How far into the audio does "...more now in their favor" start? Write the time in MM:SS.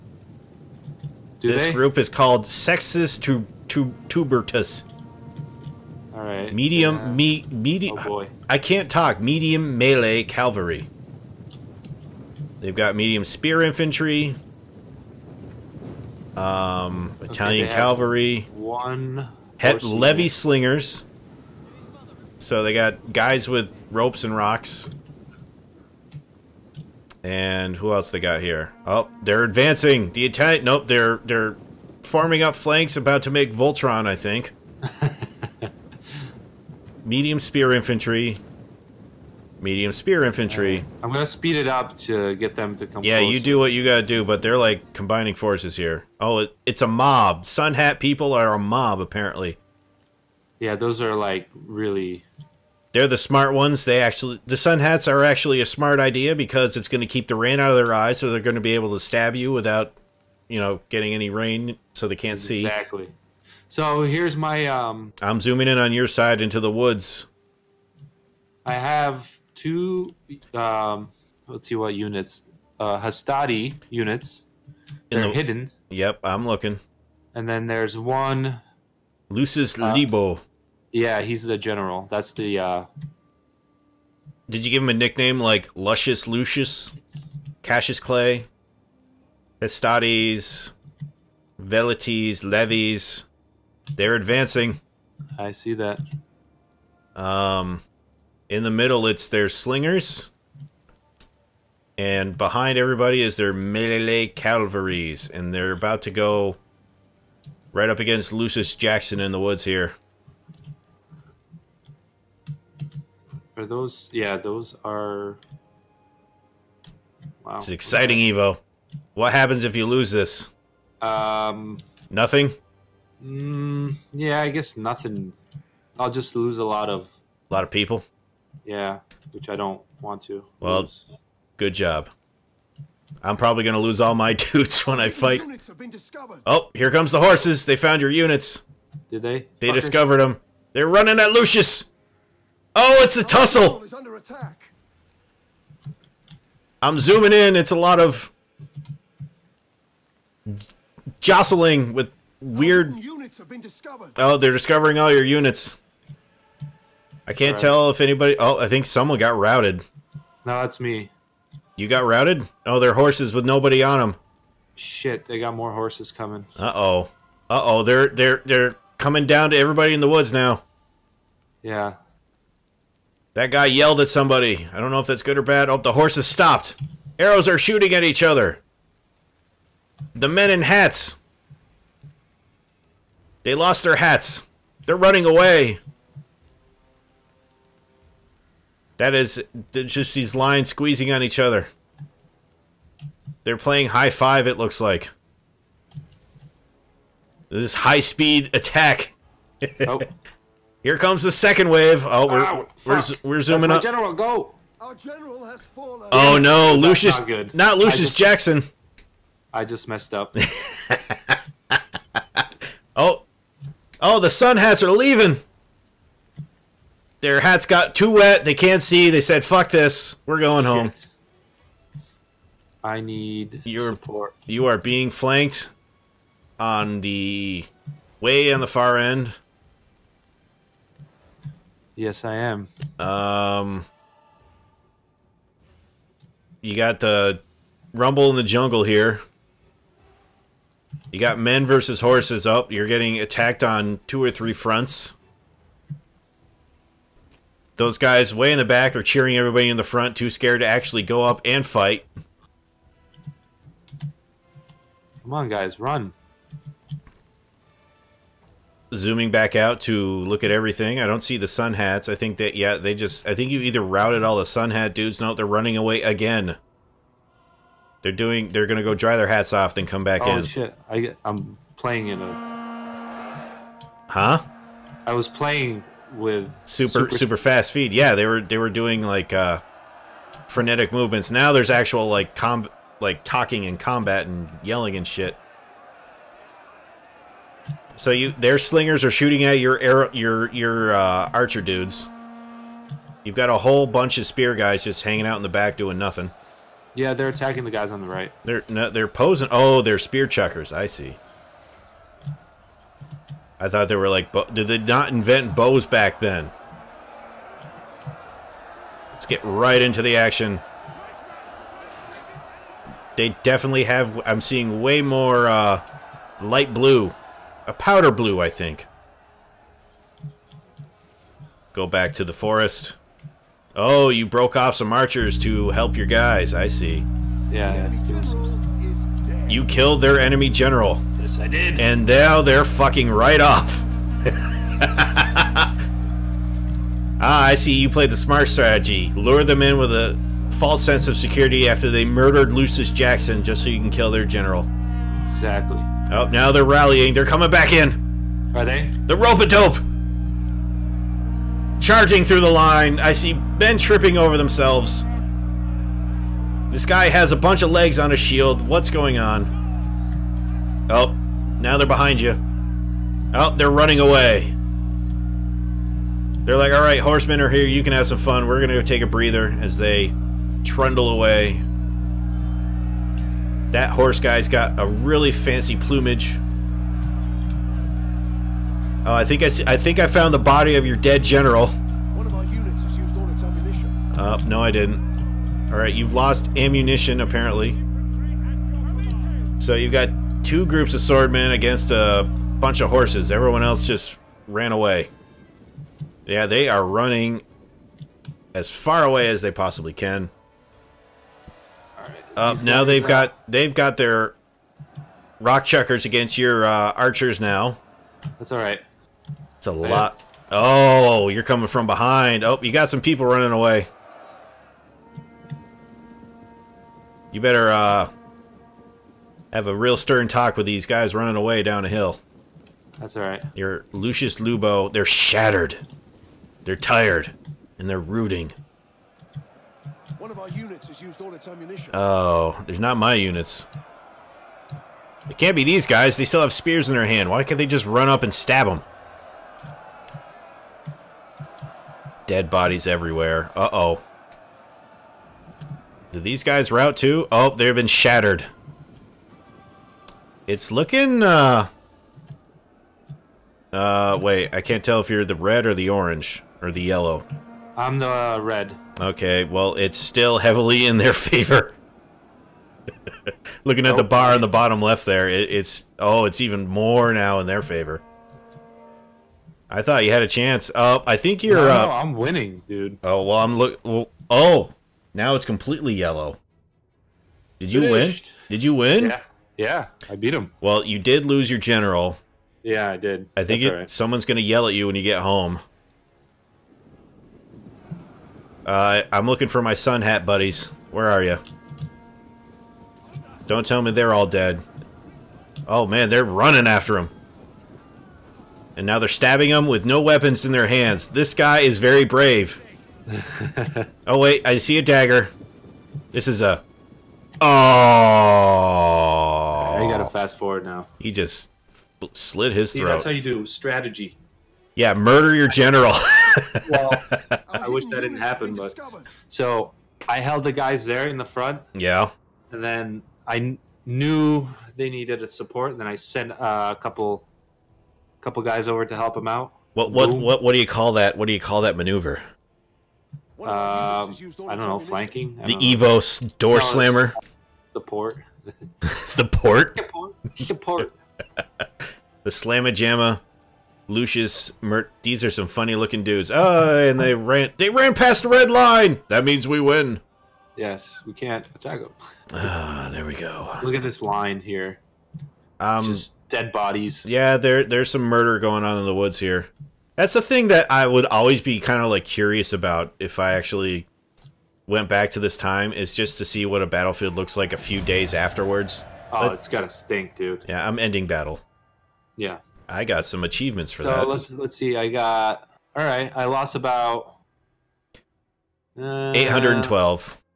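07:46.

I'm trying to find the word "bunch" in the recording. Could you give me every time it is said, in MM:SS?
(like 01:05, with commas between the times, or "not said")
04:53, 05:57, 06:32.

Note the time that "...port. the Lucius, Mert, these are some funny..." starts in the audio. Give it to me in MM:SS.
09:02.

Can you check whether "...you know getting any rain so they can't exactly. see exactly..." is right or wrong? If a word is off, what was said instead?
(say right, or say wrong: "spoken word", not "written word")
right.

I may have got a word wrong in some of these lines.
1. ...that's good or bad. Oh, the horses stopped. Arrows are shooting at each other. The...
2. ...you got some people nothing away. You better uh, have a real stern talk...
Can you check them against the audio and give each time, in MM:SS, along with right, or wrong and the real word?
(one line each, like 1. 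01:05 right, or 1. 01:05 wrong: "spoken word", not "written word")
1. 02:55 right
2. 06:52 wrong: "running", not "nothing".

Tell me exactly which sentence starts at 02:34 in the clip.
Oh, they're discovering all your units.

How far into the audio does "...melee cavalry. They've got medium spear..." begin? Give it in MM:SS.
00:09.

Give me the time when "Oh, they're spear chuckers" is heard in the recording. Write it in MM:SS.
04:59.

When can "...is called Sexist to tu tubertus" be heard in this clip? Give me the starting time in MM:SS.
00:01.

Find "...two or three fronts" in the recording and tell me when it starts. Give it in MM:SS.
04:04.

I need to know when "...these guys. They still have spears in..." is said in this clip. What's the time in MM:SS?
07:15.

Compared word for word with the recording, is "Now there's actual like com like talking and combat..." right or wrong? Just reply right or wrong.
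right.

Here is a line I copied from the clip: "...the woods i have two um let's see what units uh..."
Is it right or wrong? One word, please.
right.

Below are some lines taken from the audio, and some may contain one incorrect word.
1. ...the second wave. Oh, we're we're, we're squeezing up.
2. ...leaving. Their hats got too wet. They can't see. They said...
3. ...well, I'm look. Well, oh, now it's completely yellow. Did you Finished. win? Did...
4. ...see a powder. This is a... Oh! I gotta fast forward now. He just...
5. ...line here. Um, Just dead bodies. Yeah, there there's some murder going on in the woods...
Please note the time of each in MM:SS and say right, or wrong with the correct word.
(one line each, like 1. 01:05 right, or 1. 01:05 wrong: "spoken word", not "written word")
1. 03:21 wrong: "zooming", not "squeezing"
2. 03:34 right
3. 07:53 right
4. 08:24 wrong: "dagger", not "powder"
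5. 09:14 right.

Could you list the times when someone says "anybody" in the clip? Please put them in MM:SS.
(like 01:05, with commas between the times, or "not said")
02:37.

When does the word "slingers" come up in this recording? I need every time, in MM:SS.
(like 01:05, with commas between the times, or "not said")
00:20, 01:39, 04:48.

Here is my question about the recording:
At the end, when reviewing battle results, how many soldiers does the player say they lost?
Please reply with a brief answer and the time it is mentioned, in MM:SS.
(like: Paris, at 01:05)
812, at 09:39.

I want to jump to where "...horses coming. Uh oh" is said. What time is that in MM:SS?
02:45.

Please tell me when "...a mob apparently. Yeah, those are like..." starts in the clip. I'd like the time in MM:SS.
00:48.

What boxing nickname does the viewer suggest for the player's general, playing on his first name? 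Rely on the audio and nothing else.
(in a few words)
Lucius Cassius Clay.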